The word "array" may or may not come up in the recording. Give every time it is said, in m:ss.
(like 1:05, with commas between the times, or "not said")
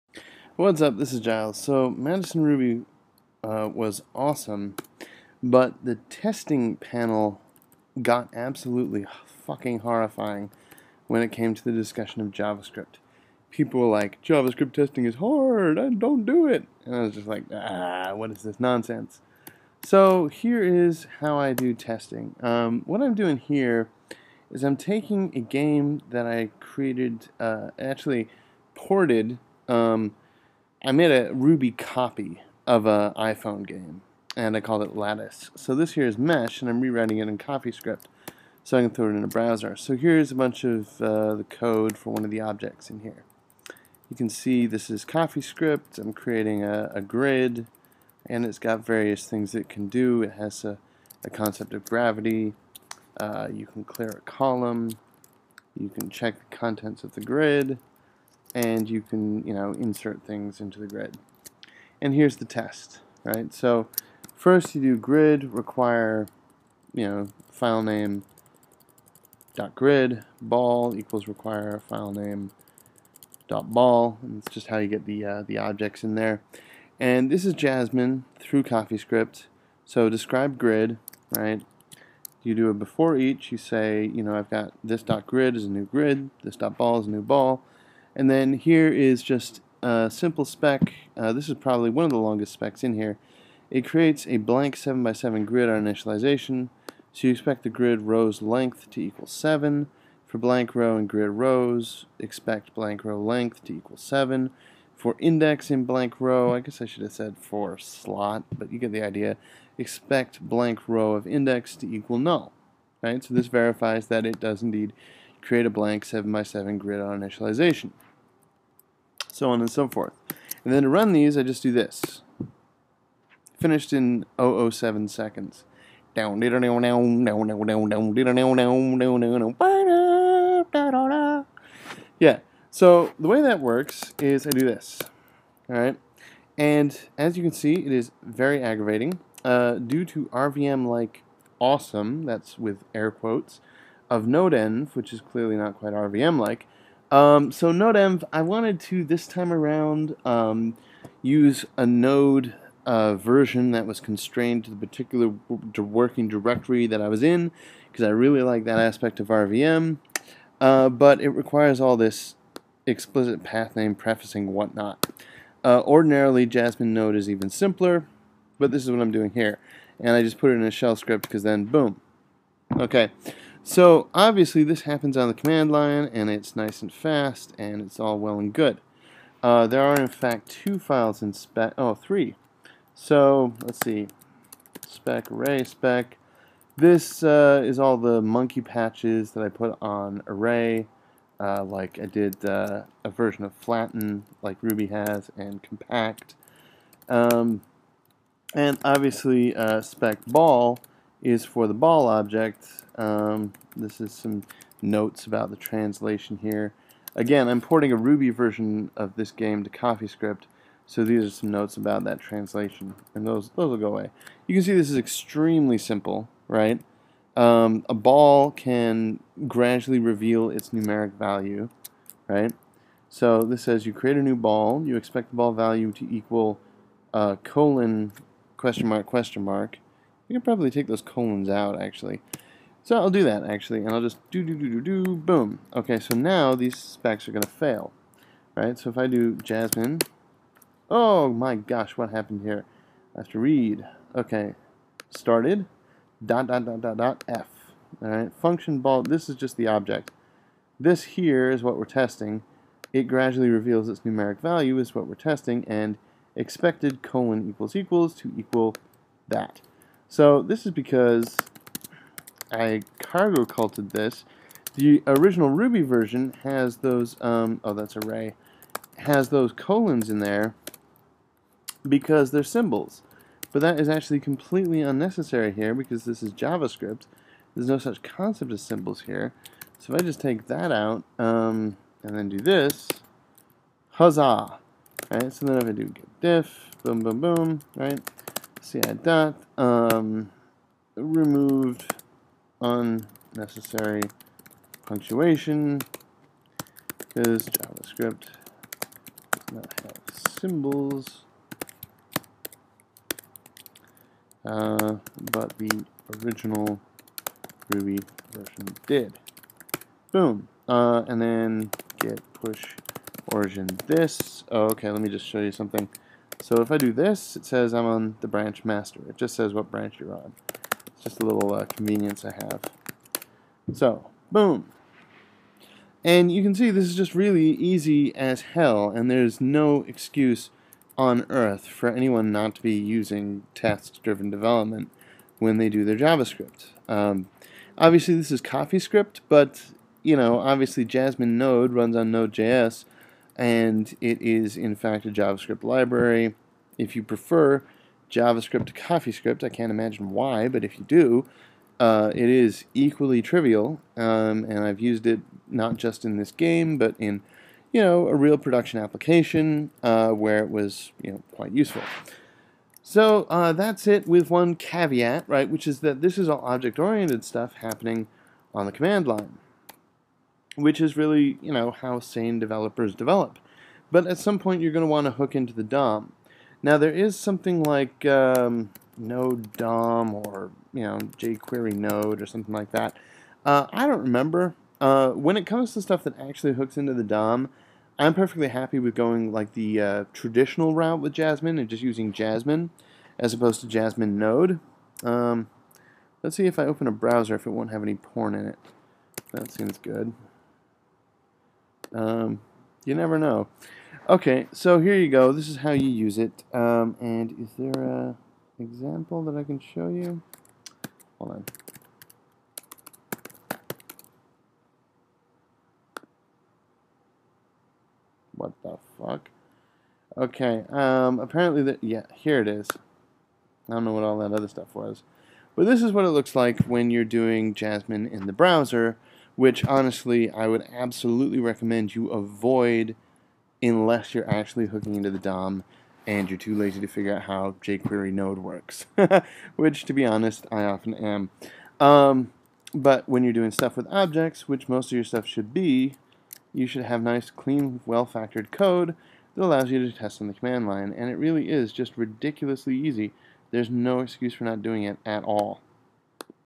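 3:05, 3:10, 4:27.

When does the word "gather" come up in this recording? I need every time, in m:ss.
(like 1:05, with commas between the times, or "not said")
not said.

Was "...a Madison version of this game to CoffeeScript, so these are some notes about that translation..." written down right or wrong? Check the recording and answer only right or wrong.
wrong.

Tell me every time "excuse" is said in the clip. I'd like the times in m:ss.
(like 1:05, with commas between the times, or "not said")
5:29, 7:33.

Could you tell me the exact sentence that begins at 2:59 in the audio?
Uh, there are in fact two files in spec, oh three.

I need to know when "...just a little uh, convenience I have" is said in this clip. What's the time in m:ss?
5:21.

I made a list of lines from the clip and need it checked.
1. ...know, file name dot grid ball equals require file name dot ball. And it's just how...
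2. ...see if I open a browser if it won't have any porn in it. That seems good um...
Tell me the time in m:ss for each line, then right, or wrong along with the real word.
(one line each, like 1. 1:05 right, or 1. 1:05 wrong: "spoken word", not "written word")
1. 1:07 right
2. 6:36 right.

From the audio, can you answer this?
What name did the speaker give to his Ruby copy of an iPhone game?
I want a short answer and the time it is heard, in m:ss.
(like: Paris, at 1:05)
Lattice, at 0:34.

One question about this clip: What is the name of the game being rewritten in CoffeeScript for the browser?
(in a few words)
Mesh.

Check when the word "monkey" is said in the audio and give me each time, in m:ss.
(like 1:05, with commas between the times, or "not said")
3:08.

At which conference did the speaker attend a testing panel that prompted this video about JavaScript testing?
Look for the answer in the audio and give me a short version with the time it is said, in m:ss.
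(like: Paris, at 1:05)
Madison Ruby, at 0:01.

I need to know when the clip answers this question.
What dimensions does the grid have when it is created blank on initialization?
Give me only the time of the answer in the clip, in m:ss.
1:34.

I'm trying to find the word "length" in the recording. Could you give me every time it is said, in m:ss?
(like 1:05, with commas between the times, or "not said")
1:38, 1:43.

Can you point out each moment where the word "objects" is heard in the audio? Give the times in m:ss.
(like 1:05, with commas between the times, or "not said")
0:42, 1:15, 3:22, 4:09, 6:06, 7:23.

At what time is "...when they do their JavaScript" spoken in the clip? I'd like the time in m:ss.
5:35.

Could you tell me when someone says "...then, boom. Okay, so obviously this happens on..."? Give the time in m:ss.
2:51.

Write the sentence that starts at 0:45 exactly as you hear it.
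I'm creating a, a grid, and it's got various things it can do.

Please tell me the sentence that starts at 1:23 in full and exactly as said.
You say, you know, I've got this dot grid is a new grid.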